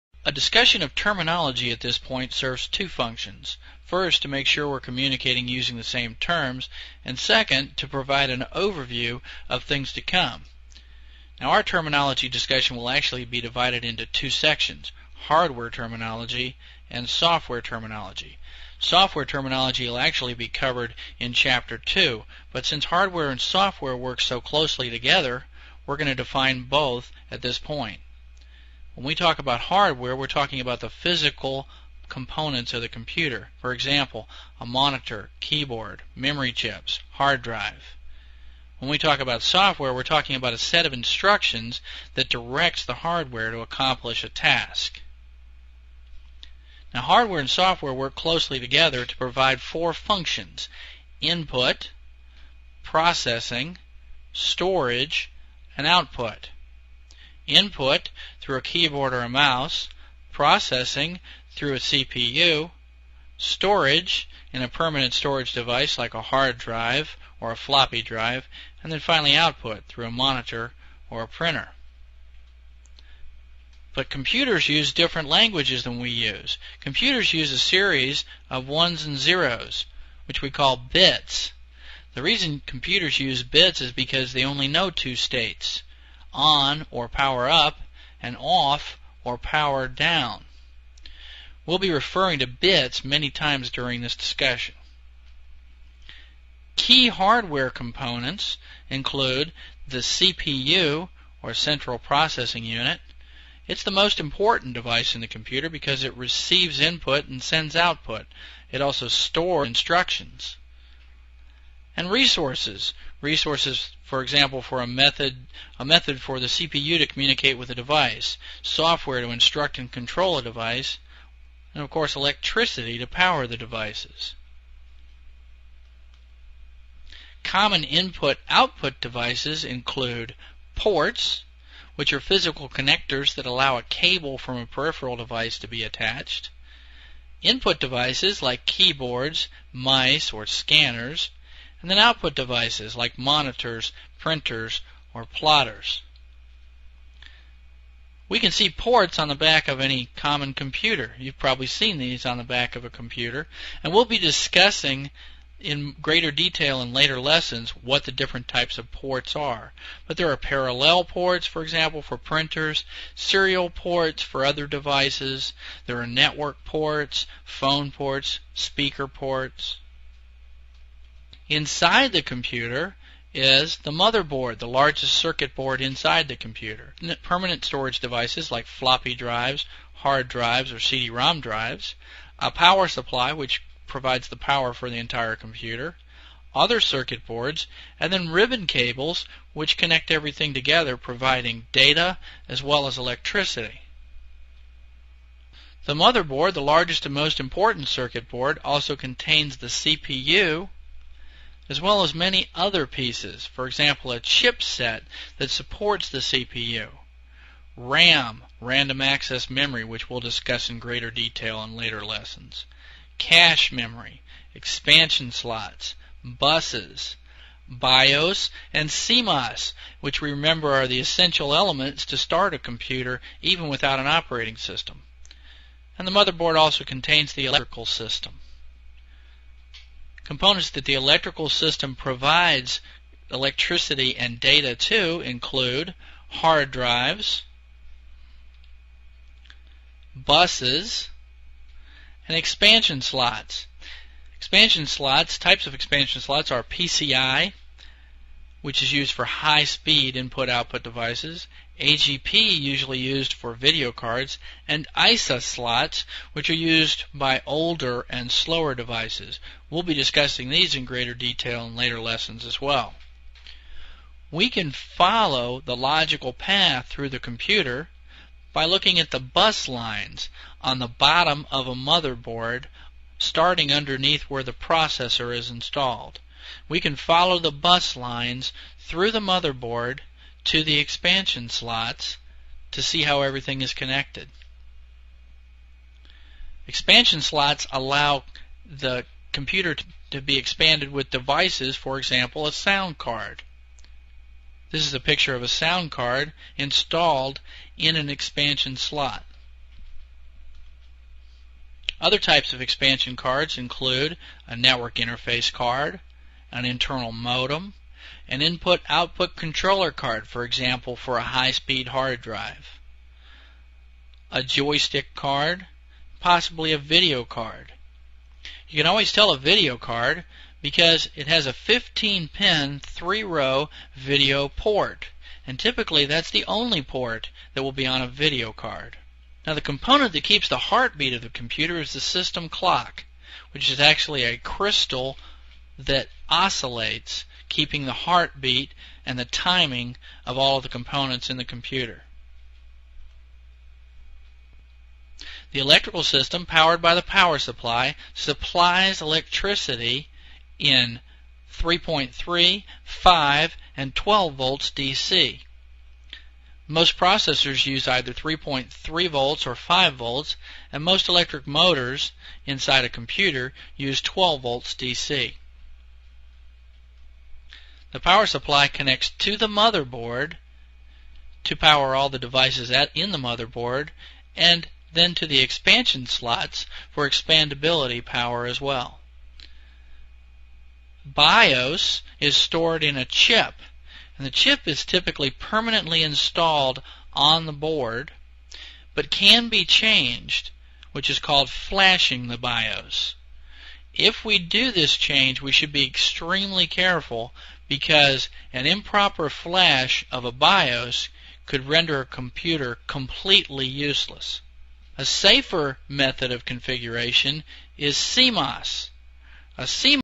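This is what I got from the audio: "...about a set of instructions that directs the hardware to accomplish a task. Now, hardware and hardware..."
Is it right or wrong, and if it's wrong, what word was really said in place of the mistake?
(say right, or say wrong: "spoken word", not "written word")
wrong: "software", not "hardware".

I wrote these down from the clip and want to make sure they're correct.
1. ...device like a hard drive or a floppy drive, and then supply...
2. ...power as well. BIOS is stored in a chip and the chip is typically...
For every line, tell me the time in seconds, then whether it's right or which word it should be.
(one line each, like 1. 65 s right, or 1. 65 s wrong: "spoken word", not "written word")
1. 65 s wrong: "finally", not "supply"
2. 378 s right.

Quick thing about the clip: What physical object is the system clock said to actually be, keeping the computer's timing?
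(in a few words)
a crystal.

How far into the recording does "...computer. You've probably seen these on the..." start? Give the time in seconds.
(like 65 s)
150 s.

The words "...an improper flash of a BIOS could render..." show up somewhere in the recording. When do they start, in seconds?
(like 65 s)
398 s.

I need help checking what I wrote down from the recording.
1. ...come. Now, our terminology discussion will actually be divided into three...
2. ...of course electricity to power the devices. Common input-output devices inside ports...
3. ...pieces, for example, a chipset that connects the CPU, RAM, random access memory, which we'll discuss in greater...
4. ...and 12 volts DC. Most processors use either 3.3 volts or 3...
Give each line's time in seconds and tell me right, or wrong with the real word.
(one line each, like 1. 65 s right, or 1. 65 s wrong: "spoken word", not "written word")
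1. 9 s wrong: "two", not "three"
2. 121 s wrong: "include", not "inside"
3. 202 s wrong: "supports", not "connects"
4. 353 s wrong: "5", not "3".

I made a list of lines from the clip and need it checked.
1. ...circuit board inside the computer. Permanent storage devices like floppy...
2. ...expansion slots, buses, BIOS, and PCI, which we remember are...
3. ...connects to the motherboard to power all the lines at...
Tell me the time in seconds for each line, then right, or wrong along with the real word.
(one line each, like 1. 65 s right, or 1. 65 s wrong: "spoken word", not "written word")
1. 175 s right
2. 214 s wrong: "CMOS", not "PCI"
3. 368 s wrong: "devices", not "lines".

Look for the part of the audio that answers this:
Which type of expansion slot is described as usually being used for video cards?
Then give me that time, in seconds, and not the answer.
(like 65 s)
251 s.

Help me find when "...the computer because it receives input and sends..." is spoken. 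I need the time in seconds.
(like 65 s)
105 s.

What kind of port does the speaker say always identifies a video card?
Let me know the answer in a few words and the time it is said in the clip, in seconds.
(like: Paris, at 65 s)
15 pin, 3 row video port, at 321 s.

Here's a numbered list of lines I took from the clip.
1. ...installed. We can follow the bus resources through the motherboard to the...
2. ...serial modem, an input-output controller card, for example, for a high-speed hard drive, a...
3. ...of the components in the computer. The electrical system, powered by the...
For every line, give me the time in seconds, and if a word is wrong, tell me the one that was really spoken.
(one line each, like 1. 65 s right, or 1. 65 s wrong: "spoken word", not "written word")
1. 275 s wrong: "lines", not "resources"
2. 306 s wrong: "internal", not "serial"
3. 340 s right.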